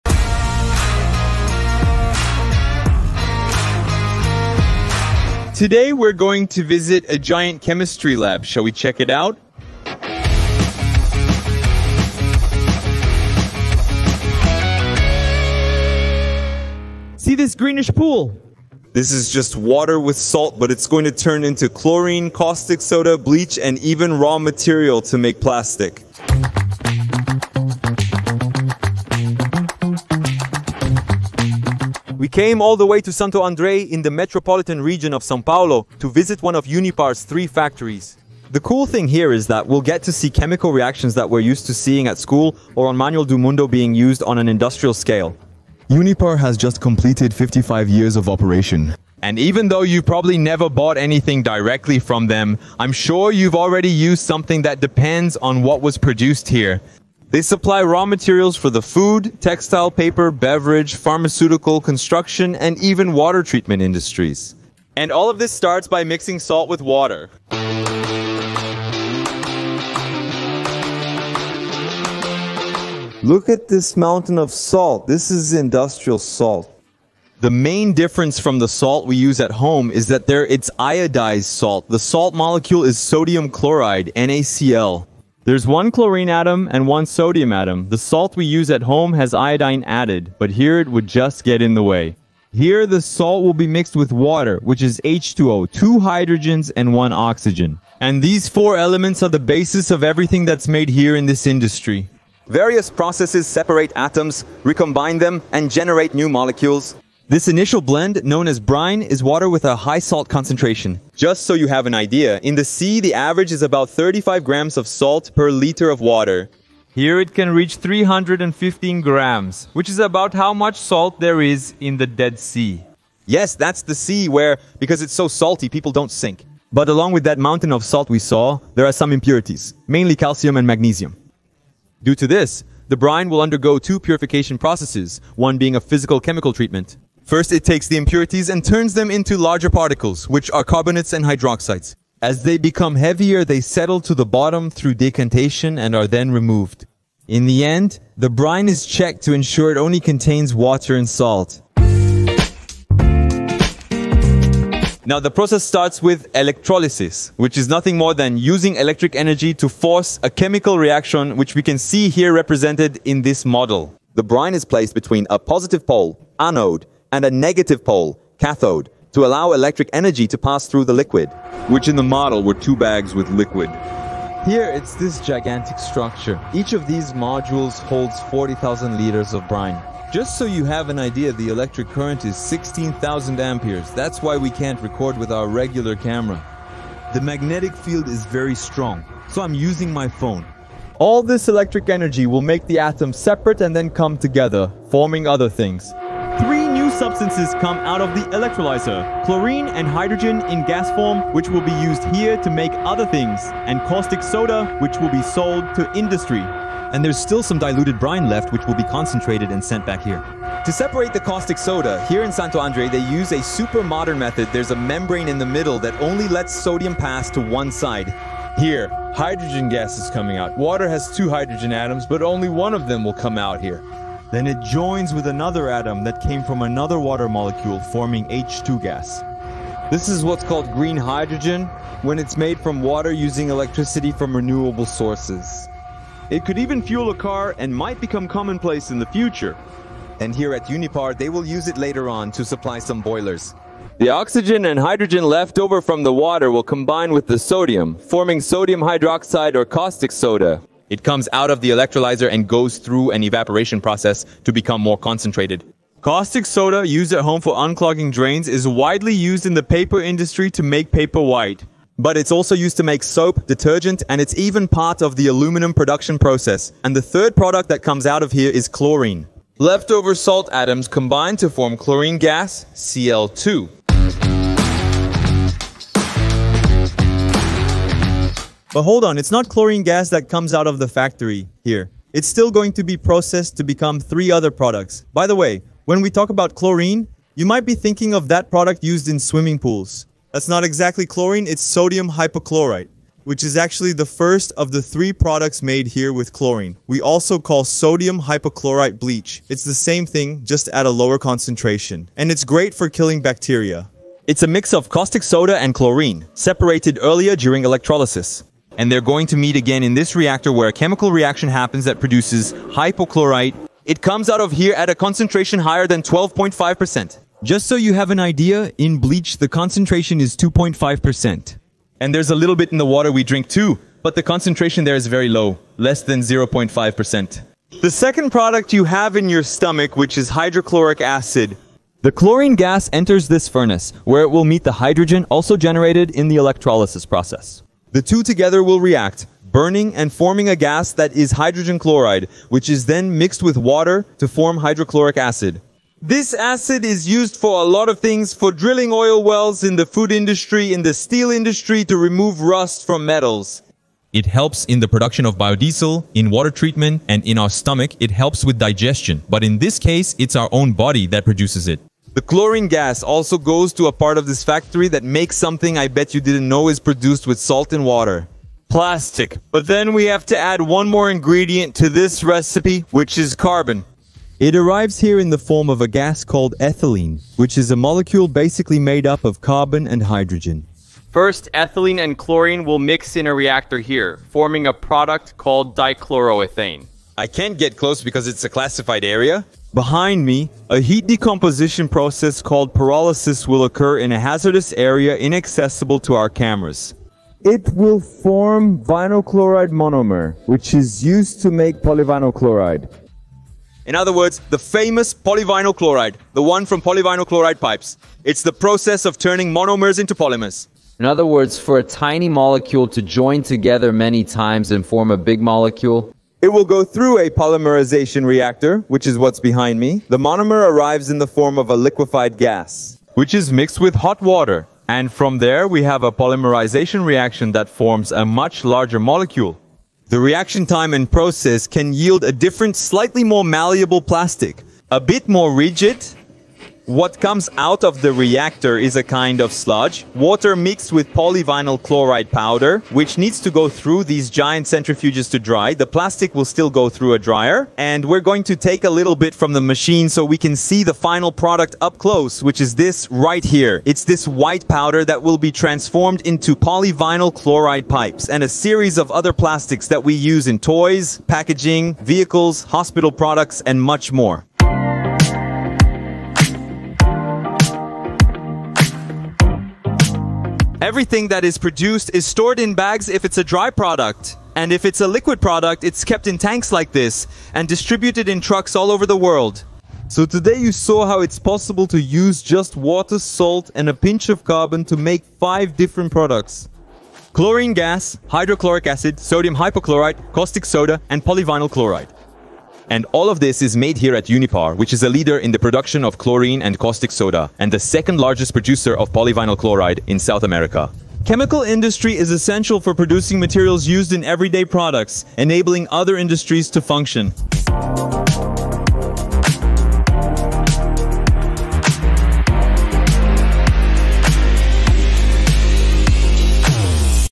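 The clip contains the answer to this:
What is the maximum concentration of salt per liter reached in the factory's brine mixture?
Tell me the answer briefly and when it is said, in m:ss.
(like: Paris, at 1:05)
315 grams, at 1:57.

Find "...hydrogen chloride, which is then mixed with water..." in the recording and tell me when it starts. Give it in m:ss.
5:41.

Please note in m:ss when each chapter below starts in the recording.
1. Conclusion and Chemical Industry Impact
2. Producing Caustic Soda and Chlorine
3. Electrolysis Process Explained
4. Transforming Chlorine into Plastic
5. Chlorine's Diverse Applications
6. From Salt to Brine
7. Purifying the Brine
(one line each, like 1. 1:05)
1. 7:50
2. 3:30
3. 2:34
4. 6:02
5. 4:29
6. 1:04
7. 2:03.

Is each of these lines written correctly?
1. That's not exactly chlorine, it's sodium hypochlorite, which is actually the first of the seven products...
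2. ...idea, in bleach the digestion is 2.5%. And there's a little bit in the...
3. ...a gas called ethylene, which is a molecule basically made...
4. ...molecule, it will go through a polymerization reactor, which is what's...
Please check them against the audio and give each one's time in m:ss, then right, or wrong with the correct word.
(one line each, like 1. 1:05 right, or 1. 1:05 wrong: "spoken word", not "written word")
1. 4:50 wrong: "three", not "seven"
2. 5:18 wrong: "concentration", not "digestion"
3. 6:15 right
4. 6:55 right.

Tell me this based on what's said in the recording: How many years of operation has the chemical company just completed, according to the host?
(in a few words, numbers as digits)
55.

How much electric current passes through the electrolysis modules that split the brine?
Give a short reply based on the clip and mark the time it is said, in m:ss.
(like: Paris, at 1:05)
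16,000 amperes, at 3:02.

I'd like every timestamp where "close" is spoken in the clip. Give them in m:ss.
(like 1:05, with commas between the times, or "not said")
6:27, 7:31.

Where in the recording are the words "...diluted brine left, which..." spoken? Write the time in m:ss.
3:27.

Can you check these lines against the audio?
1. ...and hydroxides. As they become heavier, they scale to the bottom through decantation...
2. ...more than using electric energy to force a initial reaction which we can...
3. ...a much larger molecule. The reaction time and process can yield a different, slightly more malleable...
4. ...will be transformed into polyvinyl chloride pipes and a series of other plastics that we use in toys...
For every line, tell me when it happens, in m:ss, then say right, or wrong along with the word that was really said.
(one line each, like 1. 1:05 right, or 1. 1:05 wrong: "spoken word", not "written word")
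1. 2:21 wrong: "settle", not "scale"
2. 2:37 wrong: "chemical", not "initial"
3. 7:08 right
4. 7:35 right.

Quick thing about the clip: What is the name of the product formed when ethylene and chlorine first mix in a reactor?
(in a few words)
Dichloroethane.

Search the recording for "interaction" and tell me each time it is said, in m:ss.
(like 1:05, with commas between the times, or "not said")
not said.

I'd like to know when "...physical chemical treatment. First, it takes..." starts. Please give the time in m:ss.
2:15.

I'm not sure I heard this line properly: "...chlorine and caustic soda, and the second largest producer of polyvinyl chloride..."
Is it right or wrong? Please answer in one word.
right.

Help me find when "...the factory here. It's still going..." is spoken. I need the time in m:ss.
4:40.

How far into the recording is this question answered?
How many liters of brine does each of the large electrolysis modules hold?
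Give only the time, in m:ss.
2:58.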